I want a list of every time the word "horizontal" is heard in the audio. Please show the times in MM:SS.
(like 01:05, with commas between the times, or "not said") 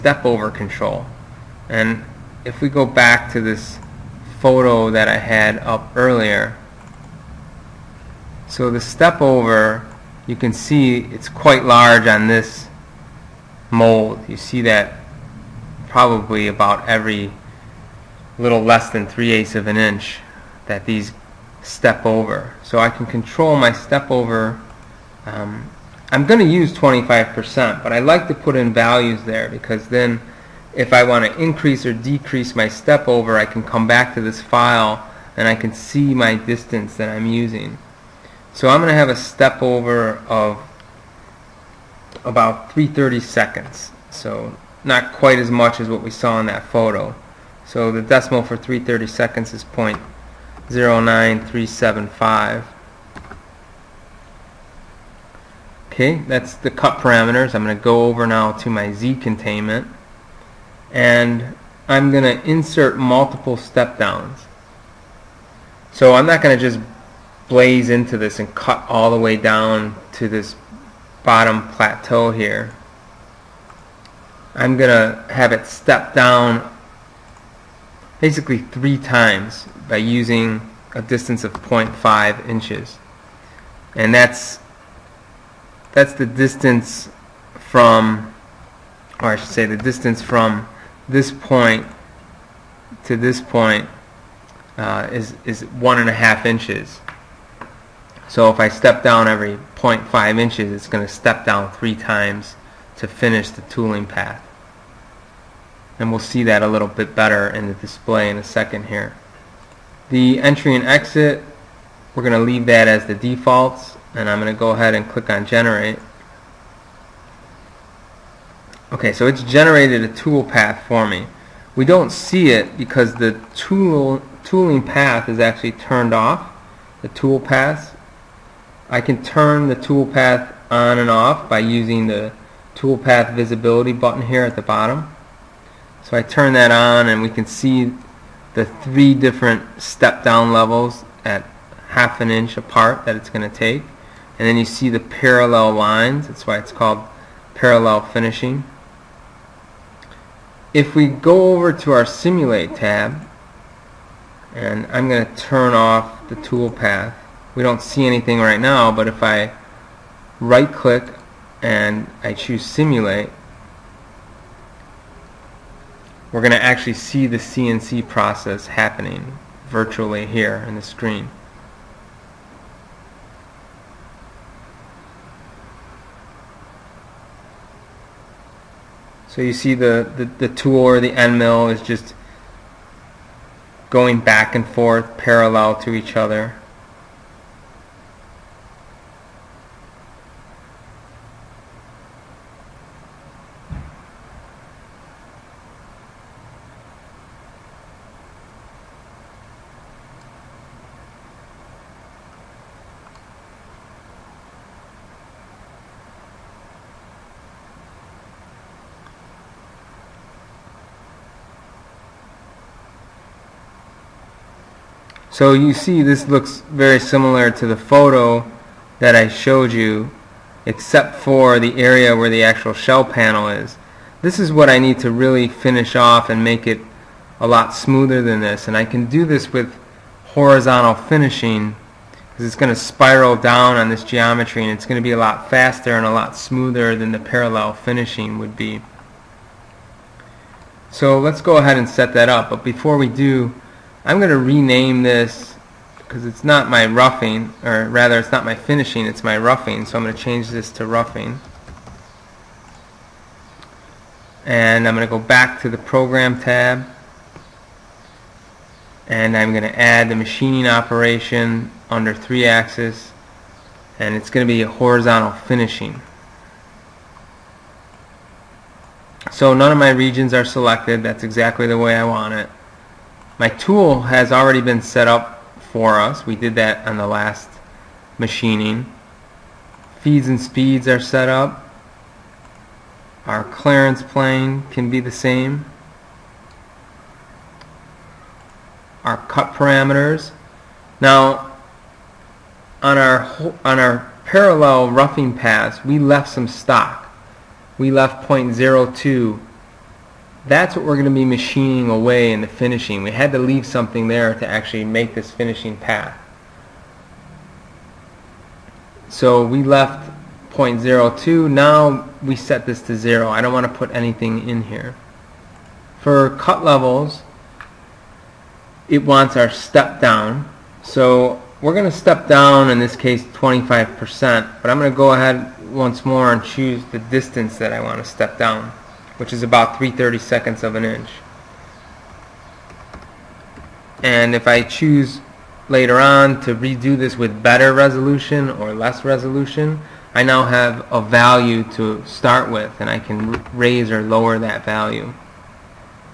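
03:50, 04:24.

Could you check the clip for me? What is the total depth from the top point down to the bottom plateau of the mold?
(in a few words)
1.5 inches.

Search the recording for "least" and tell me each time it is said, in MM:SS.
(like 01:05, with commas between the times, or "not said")
not said.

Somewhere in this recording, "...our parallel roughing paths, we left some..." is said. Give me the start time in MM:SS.
04:53.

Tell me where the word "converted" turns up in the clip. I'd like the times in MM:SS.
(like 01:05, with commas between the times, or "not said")
not said.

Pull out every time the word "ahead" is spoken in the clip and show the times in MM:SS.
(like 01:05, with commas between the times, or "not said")
01:54, 04:01, 05:25.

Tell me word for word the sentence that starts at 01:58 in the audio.
Okay, so it's generated a tool path for me.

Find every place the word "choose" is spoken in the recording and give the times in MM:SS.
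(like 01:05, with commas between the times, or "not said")
02:42, 05:26, 05:34.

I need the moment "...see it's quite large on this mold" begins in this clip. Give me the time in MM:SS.
00:10.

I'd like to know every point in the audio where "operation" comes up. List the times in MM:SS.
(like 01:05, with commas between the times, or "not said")
04:20.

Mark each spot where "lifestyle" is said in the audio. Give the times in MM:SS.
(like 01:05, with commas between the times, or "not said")
not said.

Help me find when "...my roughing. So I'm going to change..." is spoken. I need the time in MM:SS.
04:09.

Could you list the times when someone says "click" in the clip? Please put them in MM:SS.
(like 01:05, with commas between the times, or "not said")
01:55, 02:40.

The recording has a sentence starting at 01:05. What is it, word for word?
So I'm not going to just blaze into this and cut all the way down to this bottom plateau here.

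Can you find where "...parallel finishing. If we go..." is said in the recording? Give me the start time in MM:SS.
02:27.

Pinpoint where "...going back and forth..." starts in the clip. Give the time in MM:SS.
03:03.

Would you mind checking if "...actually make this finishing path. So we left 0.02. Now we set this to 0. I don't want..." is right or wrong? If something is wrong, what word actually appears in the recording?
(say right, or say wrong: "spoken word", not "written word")
right.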